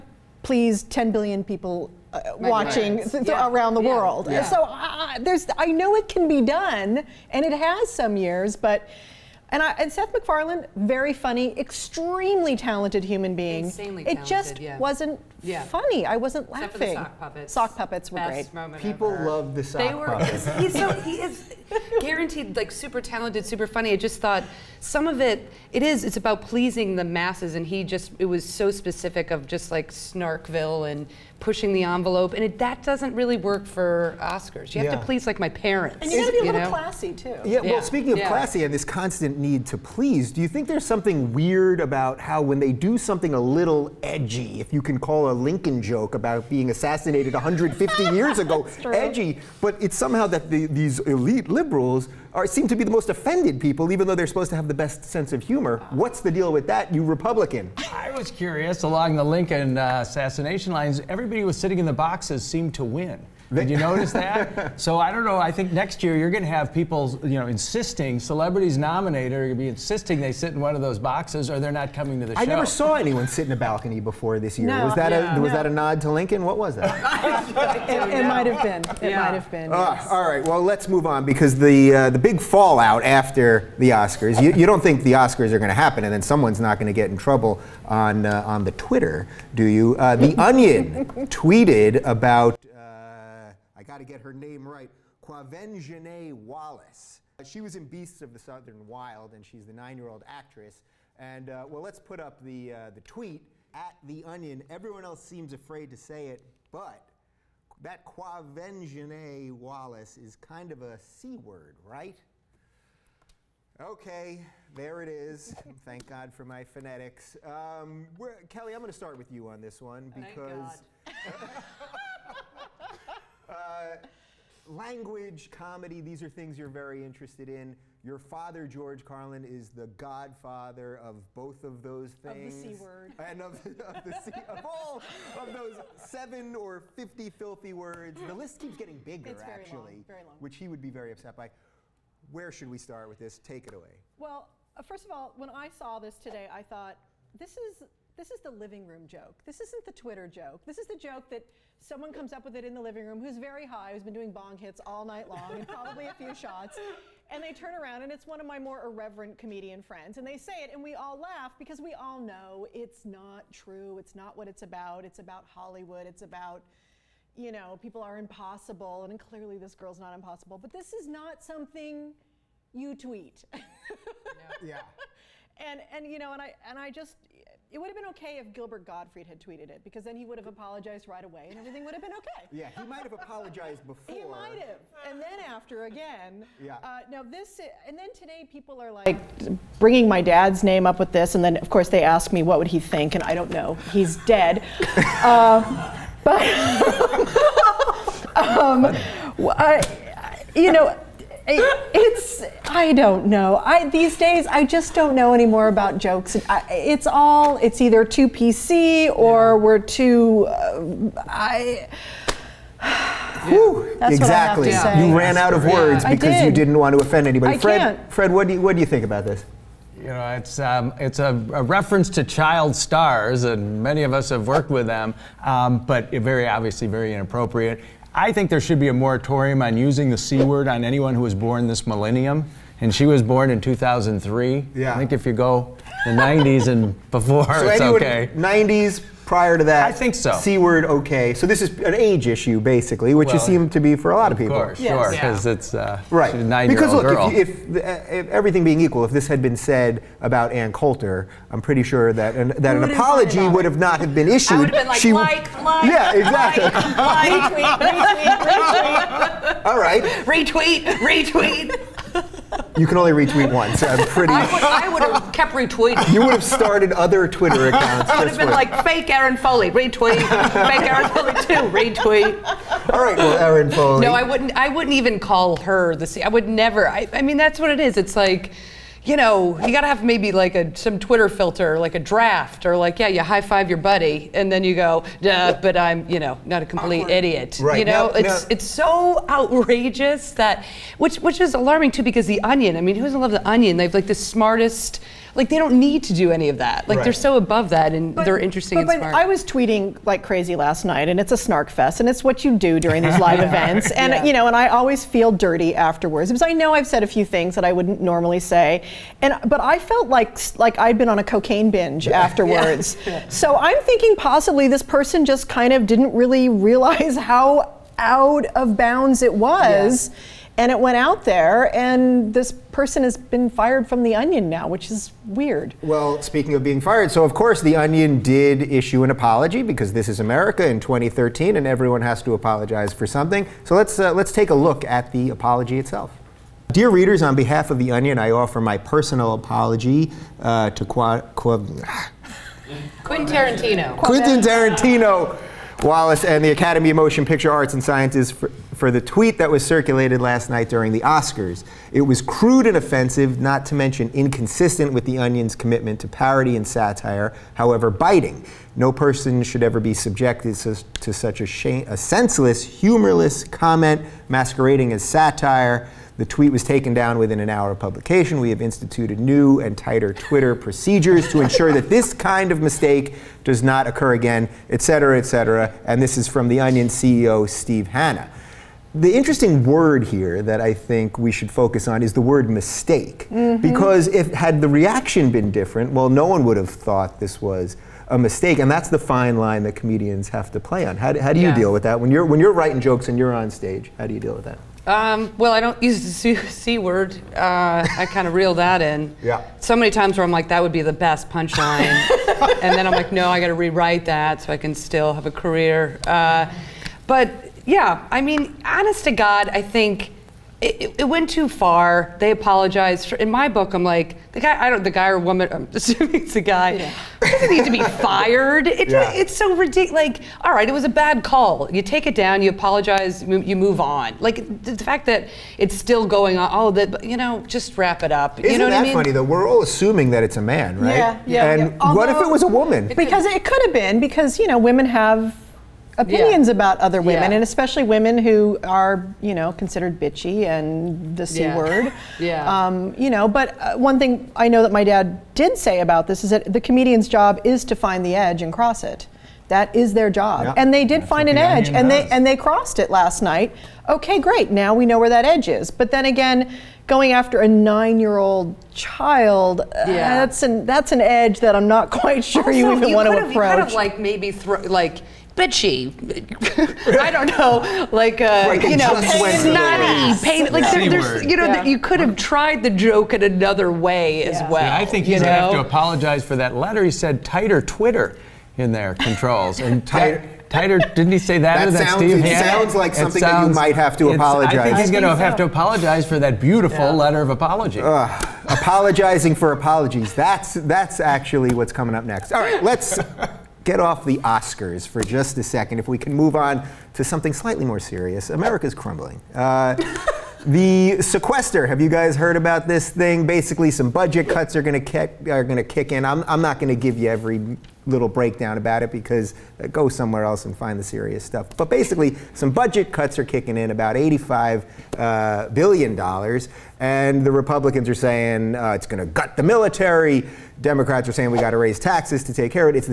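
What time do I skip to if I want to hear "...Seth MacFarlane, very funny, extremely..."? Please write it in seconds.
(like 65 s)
9 s.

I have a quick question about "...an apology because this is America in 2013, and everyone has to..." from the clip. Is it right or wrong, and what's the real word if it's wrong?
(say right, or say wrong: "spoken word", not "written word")
right.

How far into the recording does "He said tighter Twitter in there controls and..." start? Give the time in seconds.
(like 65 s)
476 s.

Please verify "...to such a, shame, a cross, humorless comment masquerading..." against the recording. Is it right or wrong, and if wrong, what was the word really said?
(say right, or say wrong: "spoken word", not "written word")
wrong: "senseless", not "cross".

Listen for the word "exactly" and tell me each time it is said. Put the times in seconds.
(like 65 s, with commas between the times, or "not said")
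214 s, 256 s.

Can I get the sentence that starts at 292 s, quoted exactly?
I mean, who doesn't love the Onion?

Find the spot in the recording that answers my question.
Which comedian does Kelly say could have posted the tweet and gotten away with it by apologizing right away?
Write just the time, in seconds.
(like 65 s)
178 s.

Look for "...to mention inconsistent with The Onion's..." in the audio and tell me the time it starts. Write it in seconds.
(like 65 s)
353 s.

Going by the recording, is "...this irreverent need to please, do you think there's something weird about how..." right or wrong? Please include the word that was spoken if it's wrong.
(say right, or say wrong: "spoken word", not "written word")
wrong: "constant", not "irreverent".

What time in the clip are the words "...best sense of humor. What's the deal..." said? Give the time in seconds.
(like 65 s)
54 s.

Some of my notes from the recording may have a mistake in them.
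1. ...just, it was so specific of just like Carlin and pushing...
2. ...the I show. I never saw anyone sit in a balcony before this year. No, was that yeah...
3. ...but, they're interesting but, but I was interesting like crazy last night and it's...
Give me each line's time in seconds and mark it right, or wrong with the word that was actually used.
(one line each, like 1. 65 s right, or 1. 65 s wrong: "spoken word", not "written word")
1. 27 s wrong: "Snarkville", not "Carlin"
2. 72 s right
3. 298 s wrong: "tweeting", not "interesting".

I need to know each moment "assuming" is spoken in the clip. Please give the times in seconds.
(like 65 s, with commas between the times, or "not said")
415 s, 429 s.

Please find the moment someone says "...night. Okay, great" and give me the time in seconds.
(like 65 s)
453 s.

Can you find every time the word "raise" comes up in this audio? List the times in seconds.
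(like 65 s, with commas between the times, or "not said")
521 s.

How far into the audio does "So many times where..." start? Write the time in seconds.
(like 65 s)
399 s.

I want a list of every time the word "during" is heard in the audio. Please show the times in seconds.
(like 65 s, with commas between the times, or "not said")
302 s, 350 s.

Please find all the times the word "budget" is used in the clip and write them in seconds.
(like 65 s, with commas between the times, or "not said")
503 s, 512 s.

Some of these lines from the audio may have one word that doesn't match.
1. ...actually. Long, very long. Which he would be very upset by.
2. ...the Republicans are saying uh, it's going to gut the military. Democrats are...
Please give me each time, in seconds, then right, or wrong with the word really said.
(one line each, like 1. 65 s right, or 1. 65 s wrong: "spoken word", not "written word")
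1. 139 s right
2. 517 s right.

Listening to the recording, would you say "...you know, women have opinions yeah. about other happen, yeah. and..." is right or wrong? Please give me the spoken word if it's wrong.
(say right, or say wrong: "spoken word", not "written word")
wrong: "women", not "happen".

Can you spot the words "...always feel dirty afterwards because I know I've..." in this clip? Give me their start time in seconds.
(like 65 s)
304 s.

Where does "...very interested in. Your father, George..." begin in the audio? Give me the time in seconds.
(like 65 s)
126 s.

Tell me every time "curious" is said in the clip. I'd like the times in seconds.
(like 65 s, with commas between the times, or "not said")
58 s.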